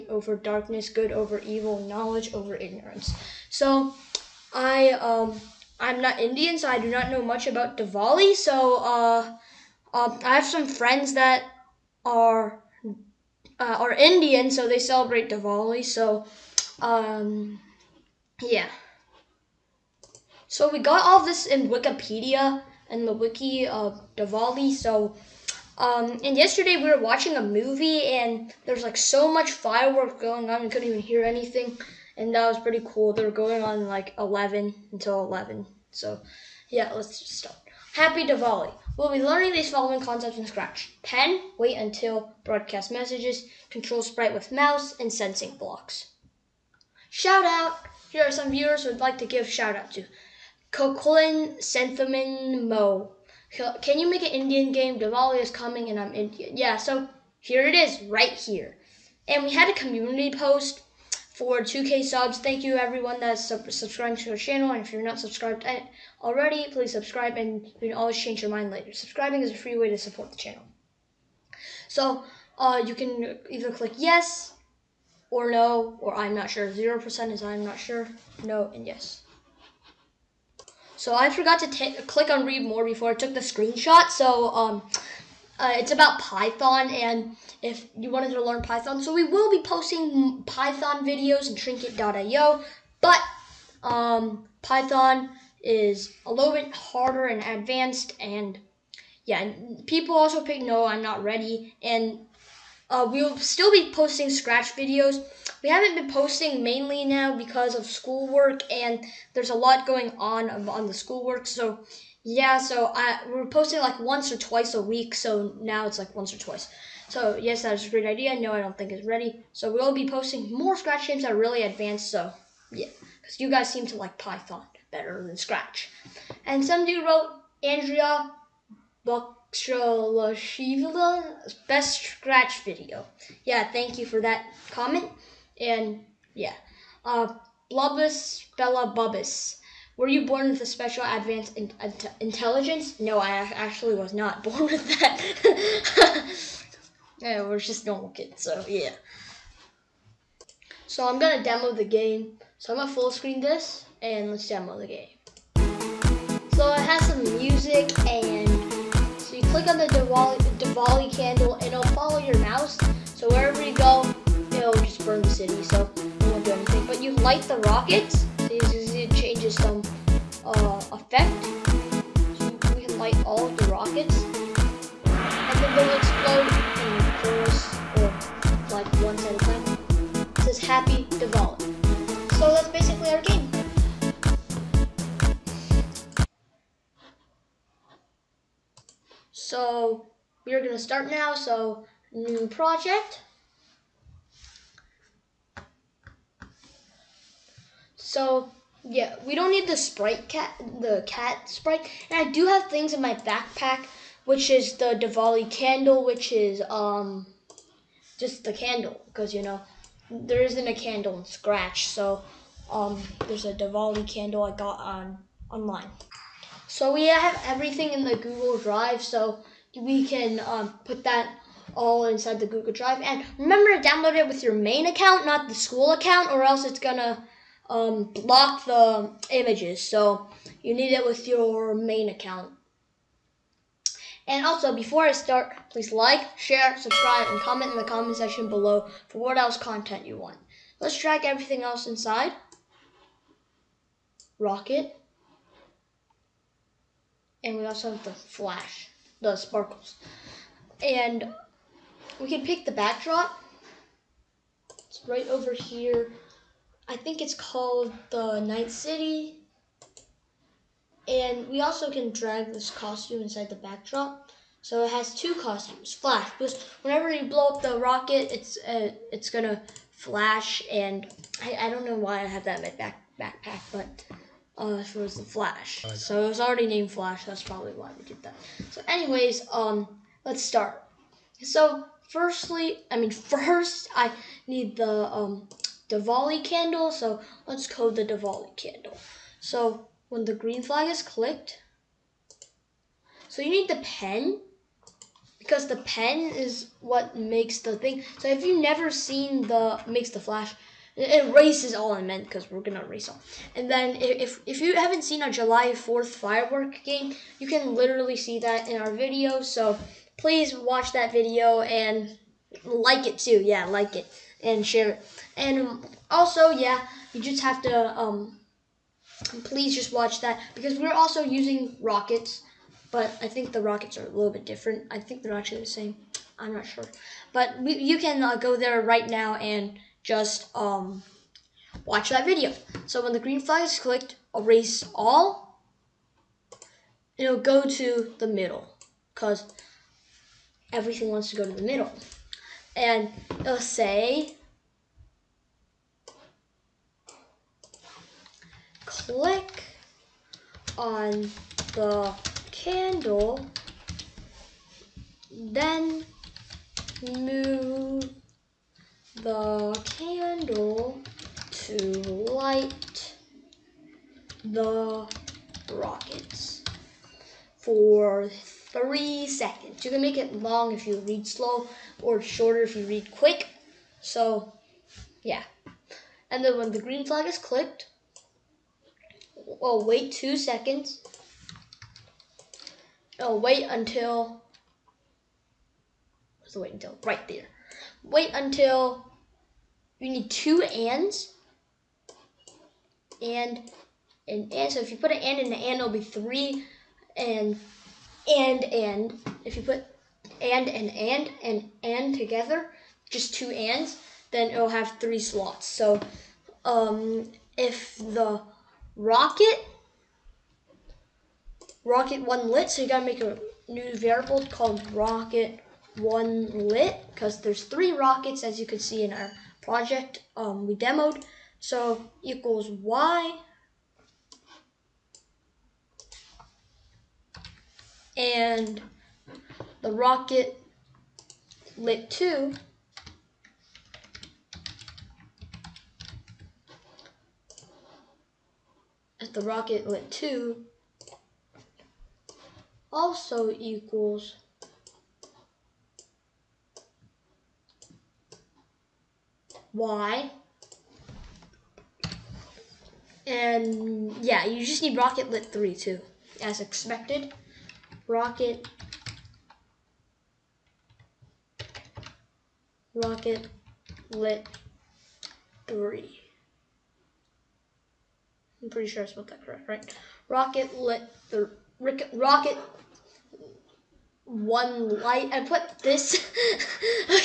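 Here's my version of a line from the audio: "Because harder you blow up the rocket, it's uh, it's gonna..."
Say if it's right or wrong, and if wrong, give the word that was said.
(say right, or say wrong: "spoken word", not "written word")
wrong: "whenever", not "harder".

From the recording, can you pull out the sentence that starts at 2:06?
And some dude wrote Andrea Bakshaloshivla's best Scratch video.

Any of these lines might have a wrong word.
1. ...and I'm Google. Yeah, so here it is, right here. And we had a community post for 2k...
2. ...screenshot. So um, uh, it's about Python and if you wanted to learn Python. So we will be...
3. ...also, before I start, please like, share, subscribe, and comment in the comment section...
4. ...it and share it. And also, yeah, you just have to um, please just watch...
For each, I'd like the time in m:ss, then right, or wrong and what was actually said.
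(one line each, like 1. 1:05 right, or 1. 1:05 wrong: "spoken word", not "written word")
1. 0:55 wrong: "Indian", not "Google"
2. 1:23 right
3. 3:54 right
4. 5:13 right.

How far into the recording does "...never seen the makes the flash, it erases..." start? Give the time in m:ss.
4:58.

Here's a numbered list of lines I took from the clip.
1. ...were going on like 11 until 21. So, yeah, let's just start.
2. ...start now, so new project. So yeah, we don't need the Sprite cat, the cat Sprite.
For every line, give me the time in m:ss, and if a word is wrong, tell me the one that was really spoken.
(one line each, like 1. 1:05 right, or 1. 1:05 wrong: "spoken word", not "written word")
1. 0:33 wrong: "11", not "21"
2. 3:10 right.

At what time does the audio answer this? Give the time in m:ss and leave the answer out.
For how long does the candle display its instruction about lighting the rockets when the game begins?
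6:08.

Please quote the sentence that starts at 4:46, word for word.
So let's code the Diwali candle.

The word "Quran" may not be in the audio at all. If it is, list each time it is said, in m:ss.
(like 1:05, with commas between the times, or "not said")
not said.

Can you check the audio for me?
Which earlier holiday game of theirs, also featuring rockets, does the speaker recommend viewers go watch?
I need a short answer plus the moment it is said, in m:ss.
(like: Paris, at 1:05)
July Fourth firework game, at 5:05.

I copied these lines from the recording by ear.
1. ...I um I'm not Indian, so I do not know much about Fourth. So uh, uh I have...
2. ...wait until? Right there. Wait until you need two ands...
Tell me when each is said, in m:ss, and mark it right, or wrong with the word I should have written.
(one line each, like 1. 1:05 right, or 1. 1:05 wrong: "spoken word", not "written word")
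1. 0:04 wrong: "Diwali", not "Fourth"
2. 6:26 right.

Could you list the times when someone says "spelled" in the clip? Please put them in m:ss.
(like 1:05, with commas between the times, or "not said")
7:49.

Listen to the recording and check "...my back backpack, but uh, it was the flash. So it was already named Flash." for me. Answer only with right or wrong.
right.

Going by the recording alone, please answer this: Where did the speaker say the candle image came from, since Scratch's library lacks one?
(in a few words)
online.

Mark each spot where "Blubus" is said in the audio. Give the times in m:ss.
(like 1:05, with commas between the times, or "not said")
2:17.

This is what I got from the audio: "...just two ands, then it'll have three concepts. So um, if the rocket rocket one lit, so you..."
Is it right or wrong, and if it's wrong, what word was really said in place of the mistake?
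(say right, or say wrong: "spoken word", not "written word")
wrong: "slots", not "concepts".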